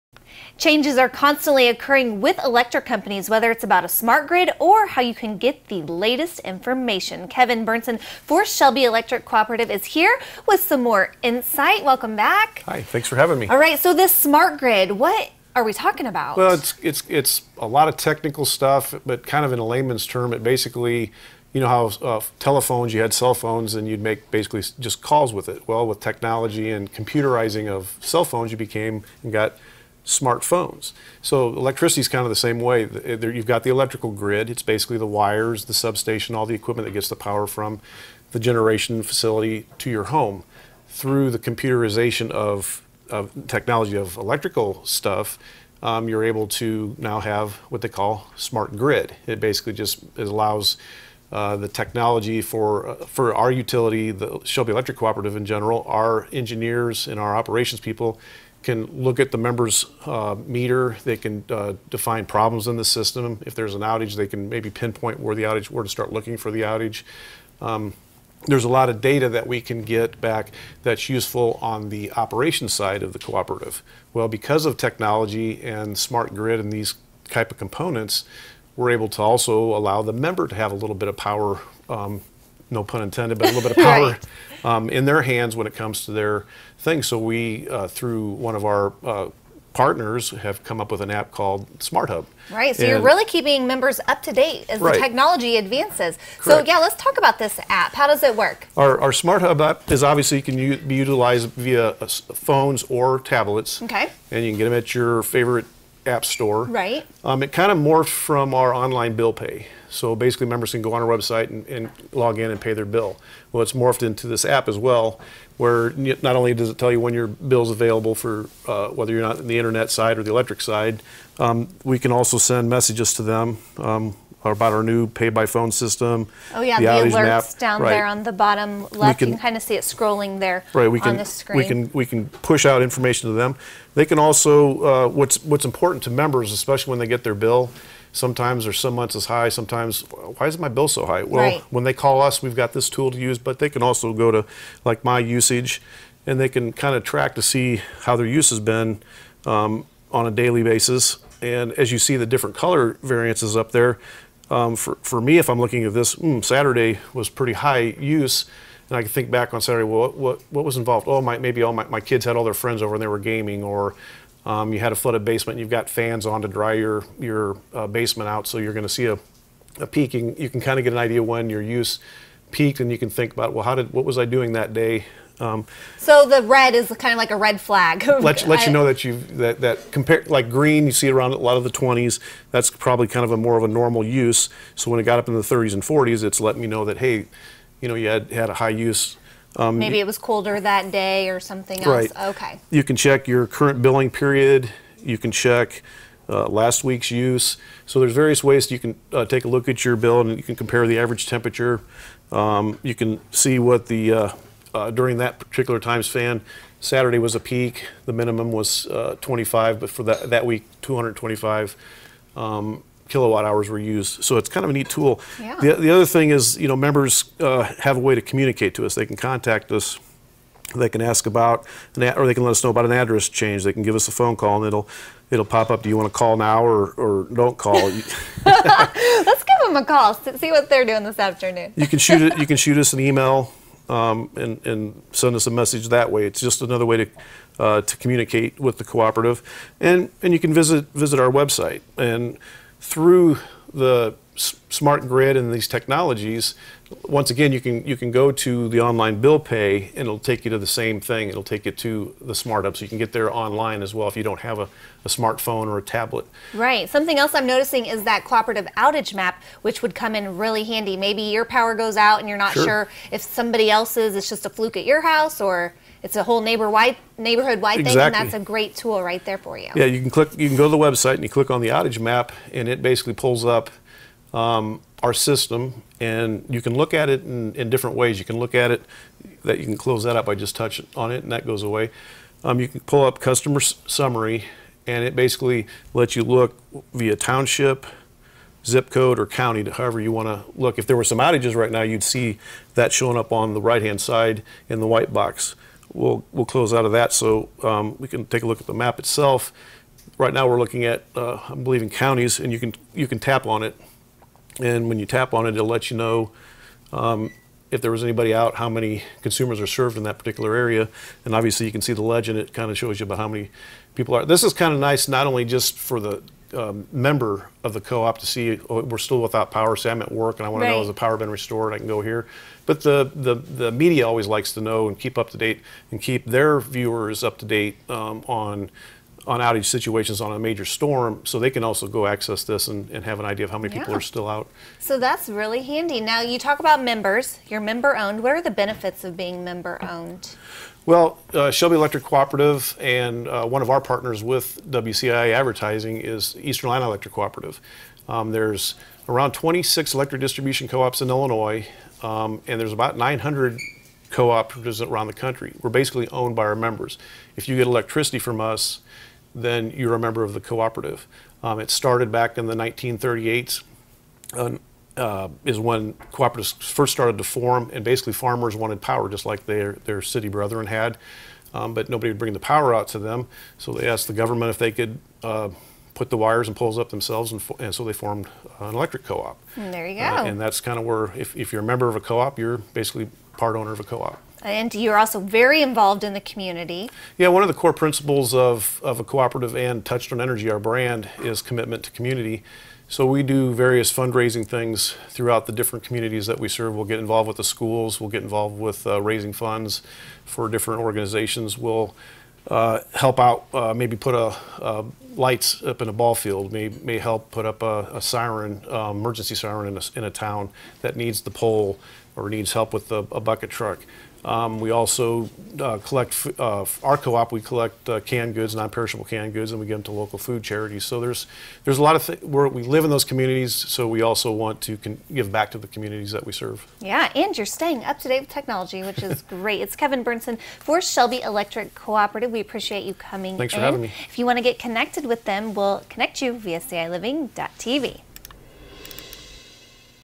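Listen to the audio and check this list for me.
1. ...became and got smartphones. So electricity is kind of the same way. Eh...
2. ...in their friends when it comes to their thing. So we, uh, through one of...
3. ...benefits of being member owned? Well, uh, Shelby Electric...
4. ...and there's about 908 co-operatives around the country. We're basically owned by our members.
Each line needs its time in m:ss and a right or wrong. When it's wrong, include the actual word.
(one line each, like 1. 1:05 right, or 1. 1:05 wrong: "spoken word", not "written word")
1. 0:28 right
2. 1:24 wrong: "hands", not "friends"
3. 5:38 right
4. 5:52 wrong: "900", not "908".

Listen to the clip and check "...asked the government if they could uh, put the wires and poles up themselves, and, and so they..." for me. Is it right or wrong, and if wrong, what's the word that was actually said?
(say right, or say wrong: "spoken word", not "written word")
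right.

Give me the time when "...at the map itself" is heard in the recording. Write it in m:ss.
4:58.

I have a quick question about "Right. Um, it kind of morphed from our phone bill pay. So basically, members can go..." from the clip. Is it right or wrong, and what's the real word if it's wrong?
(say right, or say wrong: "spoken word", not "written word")
wrong: "online", not "phone".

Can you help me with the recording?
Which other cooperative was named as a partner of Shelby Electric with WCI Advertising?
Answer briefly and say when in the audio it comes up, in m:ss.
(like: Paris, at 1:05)
Eastern Illini Electric Cooperative, at 5:46.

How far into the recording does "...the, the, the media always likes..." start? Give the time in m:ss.
5:22.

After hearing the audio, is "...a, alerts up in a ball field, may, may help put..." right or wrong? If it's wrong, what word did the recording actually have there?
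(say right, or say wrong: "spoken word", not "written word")
wrong: "lights", not "alerts".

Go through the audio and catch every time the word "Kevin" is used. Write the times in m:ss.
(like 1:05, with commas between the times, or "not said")
0:07, 7:09.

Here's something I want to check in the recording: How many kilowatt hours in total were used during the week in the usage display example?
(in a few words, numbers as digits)
225.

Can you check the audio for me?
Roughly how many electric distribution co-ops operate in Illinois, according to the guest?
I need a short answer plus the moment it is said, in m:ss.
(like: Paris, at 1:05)
26, at 5:49.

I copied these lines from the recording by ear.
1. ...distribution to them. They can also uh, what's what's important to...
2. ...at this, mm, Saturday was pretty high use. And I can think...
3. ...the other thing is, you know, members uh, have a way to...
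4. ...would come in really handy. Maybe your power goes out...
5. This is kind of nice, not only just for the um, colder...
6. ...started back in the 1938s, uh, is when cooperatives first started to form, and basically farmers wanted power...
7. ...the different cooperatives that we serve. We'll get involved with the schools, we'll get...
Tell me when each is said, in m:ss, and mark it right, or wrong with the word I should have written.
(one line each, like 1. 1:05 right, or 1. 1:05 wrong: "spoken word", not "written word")
1. 2:12 wrong: "information", not "distribution"
2. 2:35 right
3. 3:35 right
4. 4:19 right
5. 5:14 wrong: "member", not "colder"
6. 6:01 right
7. 6:35 wrong: "communities", not "cooperatives".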